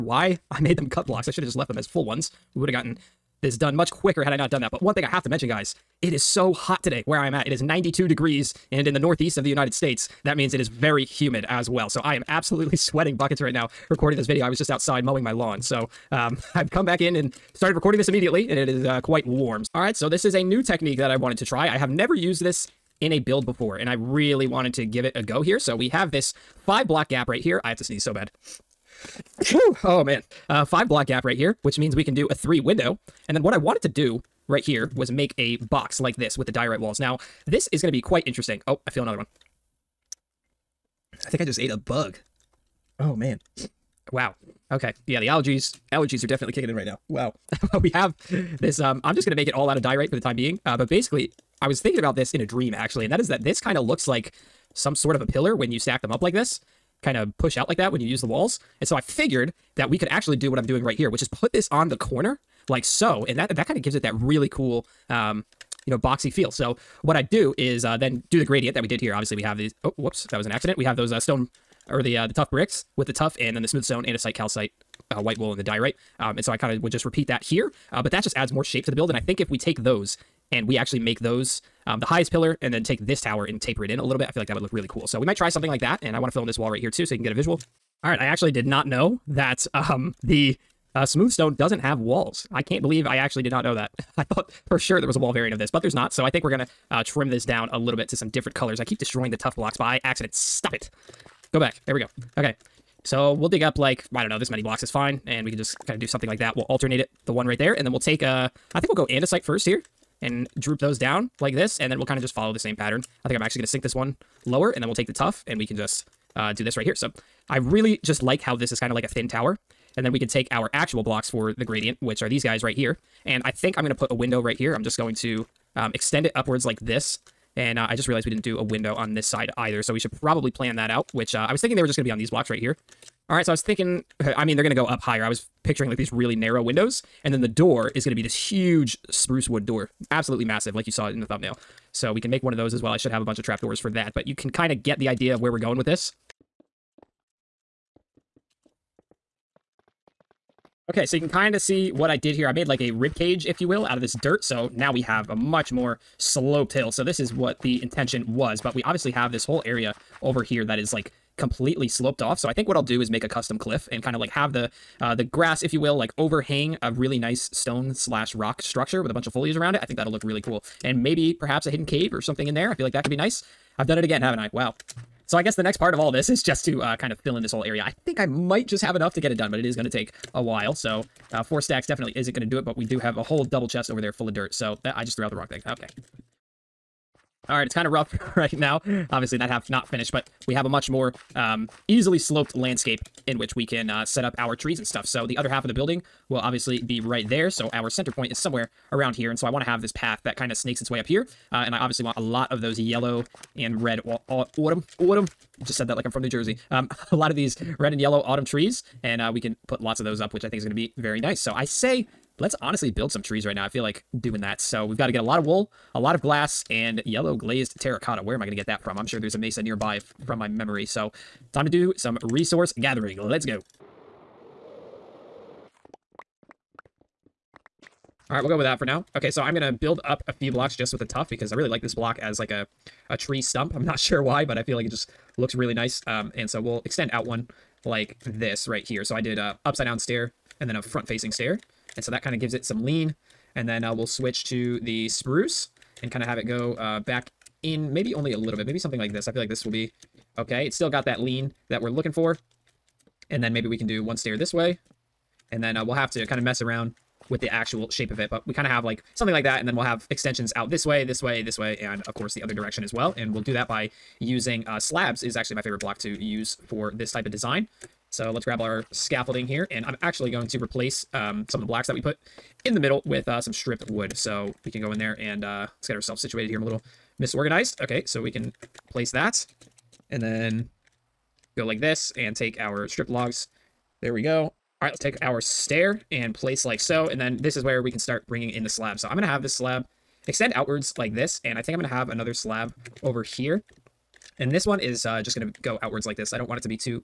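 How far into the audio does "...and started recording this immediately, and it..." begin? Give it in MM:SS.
00:17.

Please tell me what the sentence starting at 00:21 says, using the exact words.
I have never used this in a build before, and I really wanted to give it a go here.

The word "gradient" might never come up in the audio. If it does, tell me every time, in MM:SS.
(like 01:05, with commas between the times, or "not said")
01:08, 02:01.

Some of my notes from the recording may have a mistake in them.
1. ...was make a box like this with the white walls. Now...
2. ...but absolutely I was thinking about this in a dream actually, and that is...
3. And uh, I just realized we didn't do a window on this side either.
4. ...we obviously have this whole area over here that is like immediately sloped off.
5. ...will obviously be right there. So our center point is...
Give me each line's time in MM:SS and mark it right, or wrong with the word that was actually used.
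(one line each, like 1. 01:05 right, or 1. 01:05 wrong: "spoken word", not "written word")
1. 00:34 wrong: "diorite", not "white"
2. 00:50 wrong: "basically", not "absolutely"
3. 02:07 right
4. 02:38 wrong: "completely", not "immediately"
5. 03:16 right.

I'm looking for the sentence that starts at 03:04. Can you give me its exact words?
So that I just threw out the wrong thing.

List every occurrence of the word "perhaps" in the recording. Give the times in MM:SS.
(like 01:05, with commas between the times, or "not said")
02:51.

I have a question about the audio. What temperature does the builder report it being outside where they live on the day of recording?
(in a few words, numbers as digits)
92 degrees.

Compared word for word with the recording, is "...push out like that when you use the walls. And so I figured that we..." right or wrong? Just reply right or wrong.
right.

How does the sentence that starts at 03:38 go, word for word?
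Where am I going to get that from?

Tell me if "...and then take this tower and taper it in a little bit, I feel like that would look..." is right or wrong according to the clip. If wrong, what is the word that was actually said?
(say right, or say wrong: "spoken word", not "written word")
right.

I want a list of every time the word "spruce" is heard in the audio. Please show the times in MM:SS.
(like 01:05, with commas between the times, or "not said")
02:19, 04:05.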